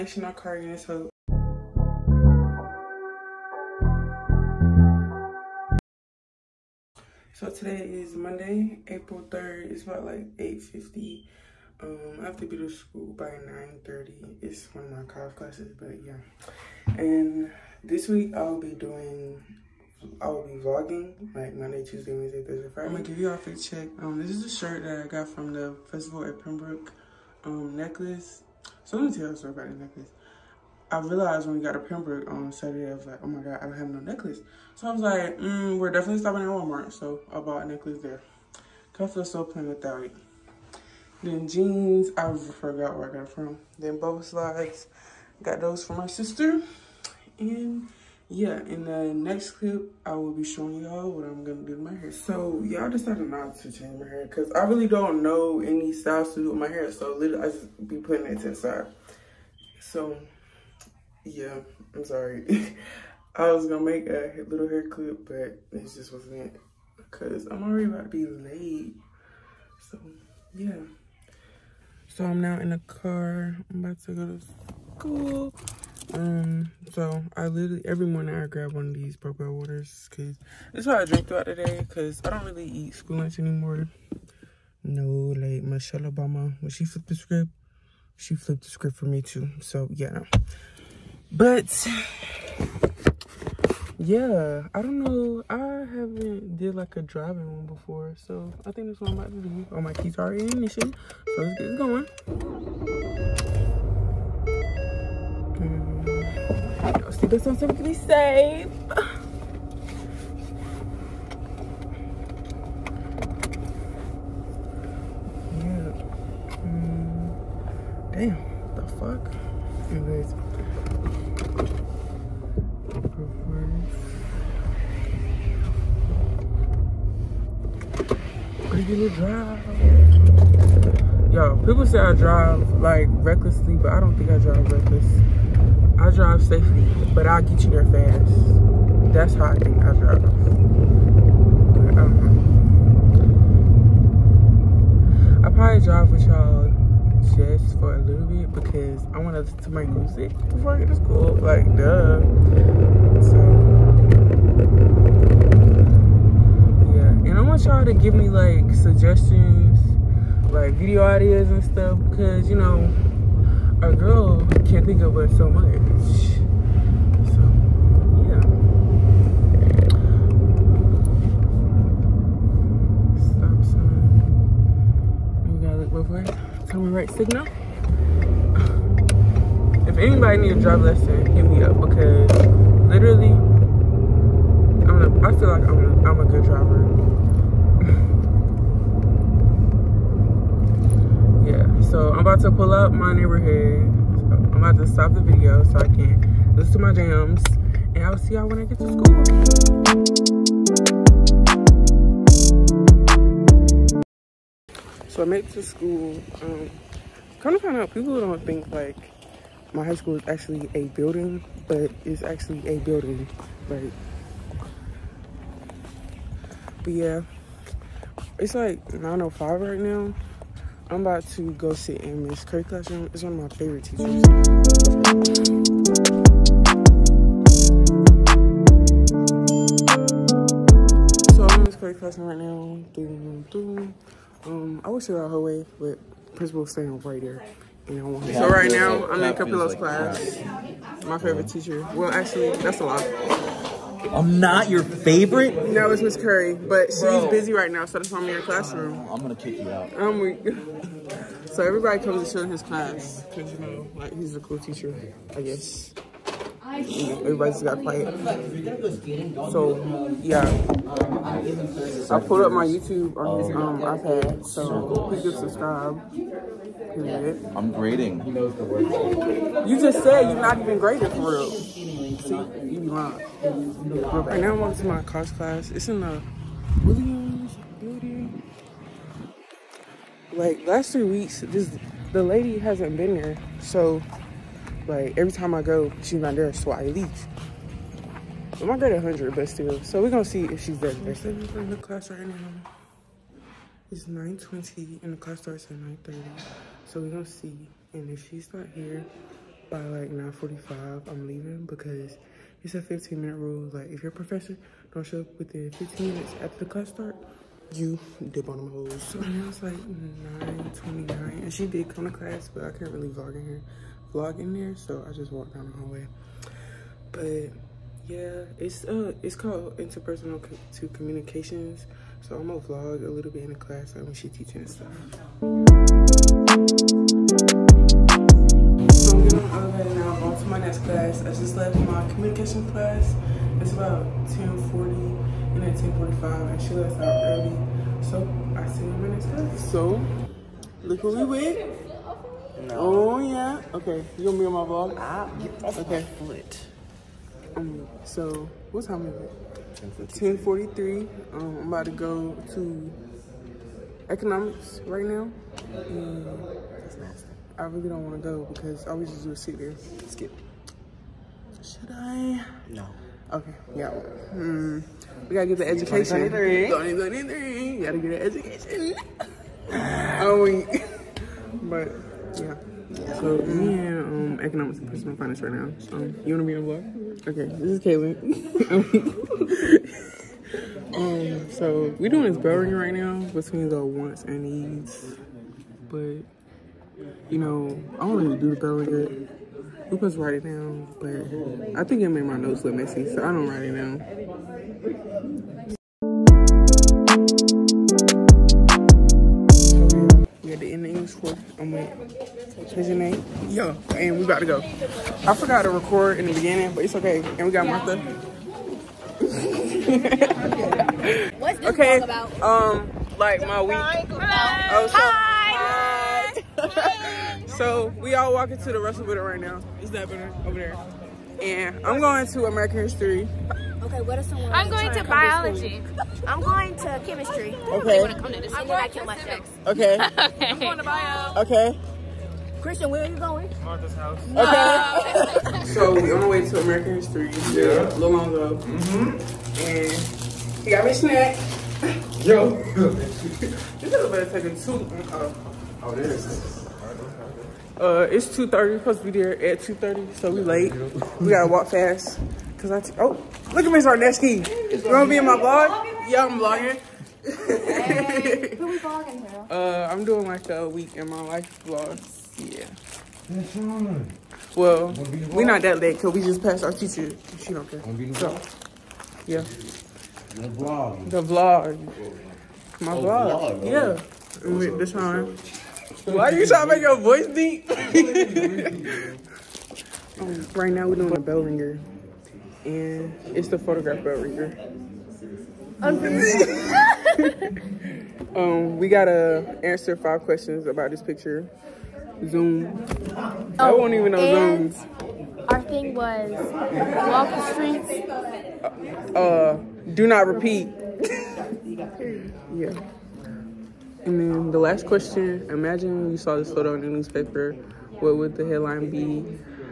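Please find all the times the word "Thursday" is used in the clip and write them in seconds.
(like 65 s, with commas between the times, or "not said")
22 s.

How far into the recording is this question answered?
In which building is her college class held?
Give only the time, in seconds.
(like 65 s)
276 s.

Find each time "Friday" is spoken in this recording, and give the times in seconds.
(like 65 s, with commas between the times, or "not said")
22 s.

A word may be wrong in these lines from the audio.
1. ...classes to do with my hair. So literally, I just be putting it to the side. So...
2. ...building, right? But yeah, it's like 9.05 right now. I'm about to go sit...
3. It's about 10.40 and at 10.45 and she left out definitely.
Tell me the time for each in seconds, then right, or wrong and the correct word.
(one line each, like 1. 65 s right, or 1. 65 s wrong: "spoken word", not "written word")
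1. 55 s wrong: "styles", not "classes"
2. 212 s right
3. 333 s wrong: "early", not "definitely".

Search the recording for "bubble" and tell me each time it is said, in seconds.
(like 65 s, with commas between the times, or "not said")
43 s.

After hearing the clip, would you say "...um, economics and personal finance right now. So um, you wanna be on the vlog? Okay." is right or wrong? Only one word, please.
right.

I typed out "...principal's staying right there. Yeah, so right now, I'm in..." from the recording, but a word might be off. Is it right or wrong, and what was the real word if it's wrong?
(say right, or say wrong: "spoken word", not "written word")
right.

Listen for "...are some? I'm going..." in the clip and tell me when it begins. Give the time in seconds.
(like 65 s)
424 s.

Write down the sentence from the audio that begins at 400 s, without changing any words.
we got the end English course.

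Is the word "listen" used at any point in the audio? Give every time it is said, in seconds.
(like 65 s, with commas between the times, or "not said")
149 s, 196 s.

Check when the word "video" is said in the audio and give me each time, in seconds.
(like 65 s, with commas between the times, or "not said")
160 s, 195 s.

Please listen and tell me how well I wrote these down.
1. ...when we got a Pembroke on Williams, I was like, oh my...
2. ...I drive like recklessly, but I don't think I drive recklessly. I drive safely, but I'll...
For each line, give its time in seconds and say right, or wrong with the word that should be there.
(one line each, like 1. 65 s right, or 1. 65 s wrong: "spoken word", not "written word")
1. 31 s wrong: "Saturday", not "Williams"
2. 131 s right.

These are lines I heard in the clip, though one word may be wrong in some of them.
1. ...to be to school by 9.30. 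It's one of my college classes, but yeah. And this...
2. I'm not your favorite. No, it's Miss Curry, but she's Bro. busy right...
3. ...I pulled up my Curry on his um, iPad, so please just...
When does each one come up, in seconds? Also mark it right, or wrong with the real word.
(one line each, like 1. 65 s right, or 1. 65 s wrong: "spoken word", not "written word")
1. 12 s right
2. 244 s right
3. 262 s wrong: "YouTube", not "Curry".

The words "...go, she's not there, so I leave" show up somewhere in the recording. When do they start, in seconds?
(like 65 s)
285 s.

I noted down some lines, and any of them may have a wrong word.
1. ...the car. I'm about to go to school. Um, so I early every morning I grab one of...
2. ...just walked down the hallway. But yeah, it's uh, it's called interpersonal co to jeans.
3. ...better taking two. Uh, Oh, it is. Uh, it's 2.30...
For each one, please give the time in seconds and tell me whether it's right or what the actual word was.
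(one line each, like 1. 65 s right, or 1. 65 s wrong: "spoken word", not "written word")
1. 72 s wrong: "literally", not "early"
2. 315 s wrong: "communications", not "jeans"
3. 444 s right.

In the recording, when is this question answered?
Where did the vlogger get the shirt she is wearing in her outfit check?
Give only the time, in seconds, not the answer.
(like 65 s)
25 s.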